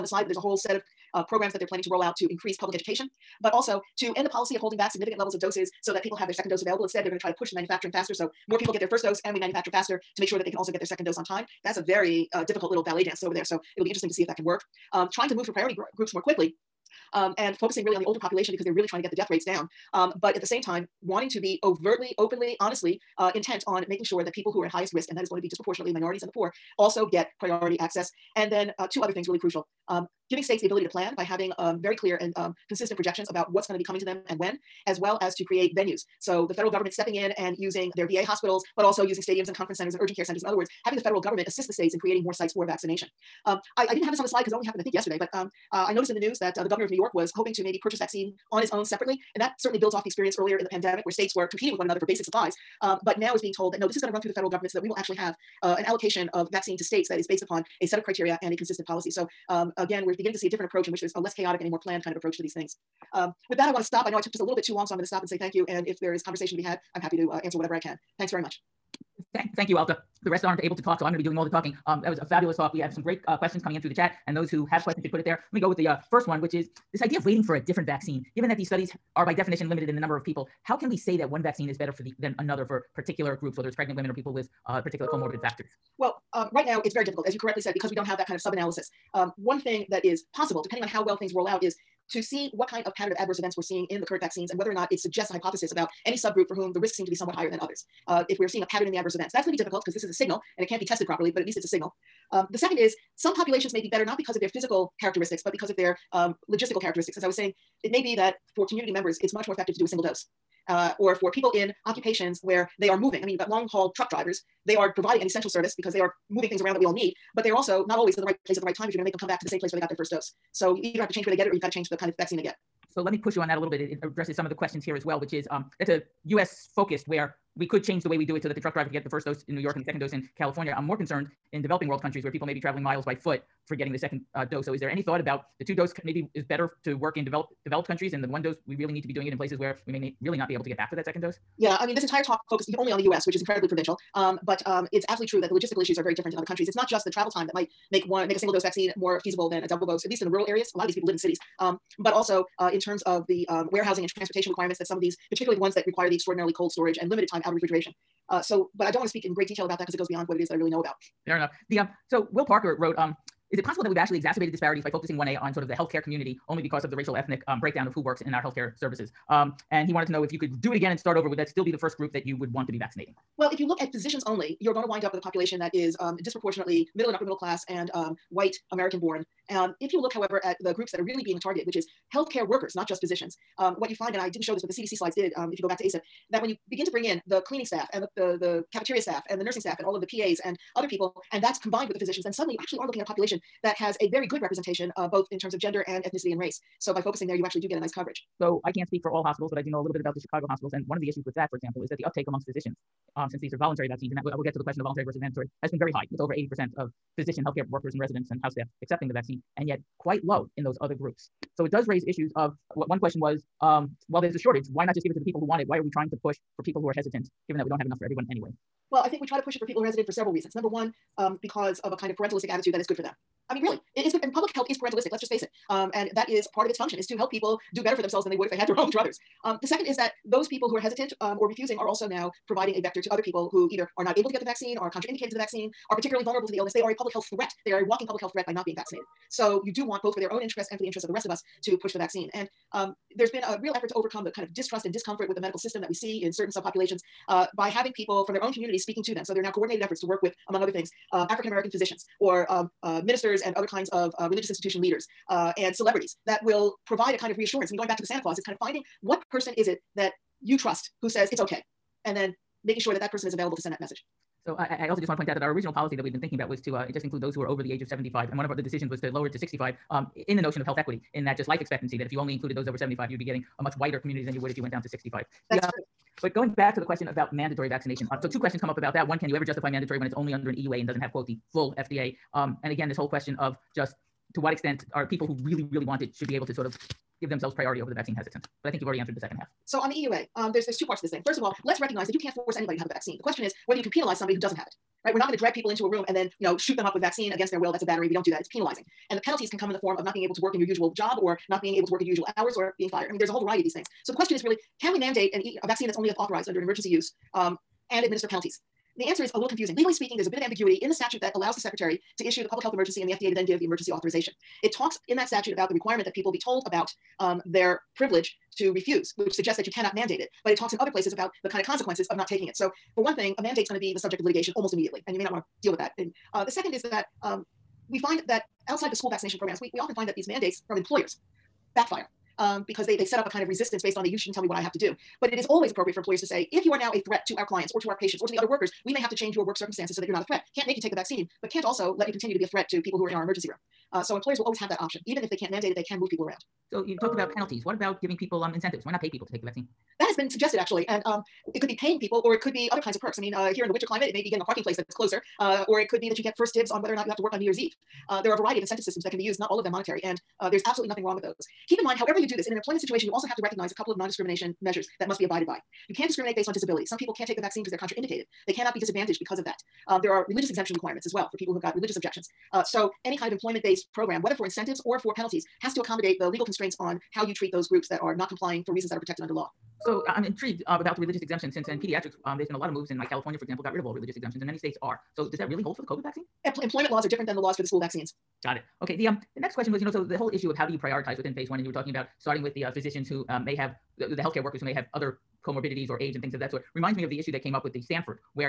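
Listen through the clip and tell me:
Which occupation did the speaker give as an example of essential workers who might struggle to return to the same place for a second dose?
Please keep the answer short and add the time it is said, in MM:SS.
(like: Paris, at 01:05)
Long haul truck drivers, at 01:53.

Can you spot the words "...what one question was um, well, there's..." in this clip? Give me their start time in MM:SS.
03:32.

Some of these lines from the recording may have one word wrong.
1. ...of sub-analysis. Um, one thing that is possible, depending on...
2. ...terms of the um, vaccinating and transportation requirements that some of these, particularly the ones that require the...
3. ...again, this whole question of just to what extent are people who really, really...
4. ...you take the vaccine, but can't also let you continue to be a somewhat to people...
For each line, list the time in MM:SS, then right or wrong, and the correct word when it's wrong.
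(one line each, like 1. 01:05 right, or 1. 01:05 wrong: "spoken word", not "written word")
1. 01:28 right
2. 02:32 wrong: "warehousing", not "vaccinating"
3. 04:42 right
4. 05:40 wrong: "threat", not "somewhat".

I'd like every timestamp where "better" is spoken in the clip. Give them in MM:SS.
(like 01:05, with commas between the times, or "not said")
01:21, 01:43, 02:16, 03:47.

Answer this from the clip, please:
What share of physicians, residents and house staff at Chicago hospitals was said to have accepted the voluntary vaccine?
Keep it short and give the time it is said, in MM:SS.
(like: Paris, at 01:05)
Over 80%, at 03:26.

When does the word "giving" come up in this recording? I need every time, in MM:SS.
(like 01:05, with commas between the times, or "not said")
00:30, 05:48.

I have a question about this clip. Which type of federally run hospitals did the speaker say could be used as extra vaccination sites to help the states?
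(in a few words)
VA hospitals.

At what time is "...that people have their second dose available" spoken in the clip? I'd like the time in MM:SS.
00:05.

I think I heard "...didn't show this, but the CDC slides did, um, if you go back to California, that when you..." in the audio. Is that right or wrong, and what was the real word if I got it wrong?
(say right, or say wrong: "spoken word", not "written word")
wrong: "ACIP", not "California".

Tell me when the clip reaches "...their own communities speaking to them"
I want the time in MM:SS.
04:08.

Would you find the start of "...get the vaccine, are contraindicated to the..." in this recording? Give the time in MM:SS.
03:54.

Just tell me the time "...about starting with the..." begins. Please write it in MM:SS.
06:31.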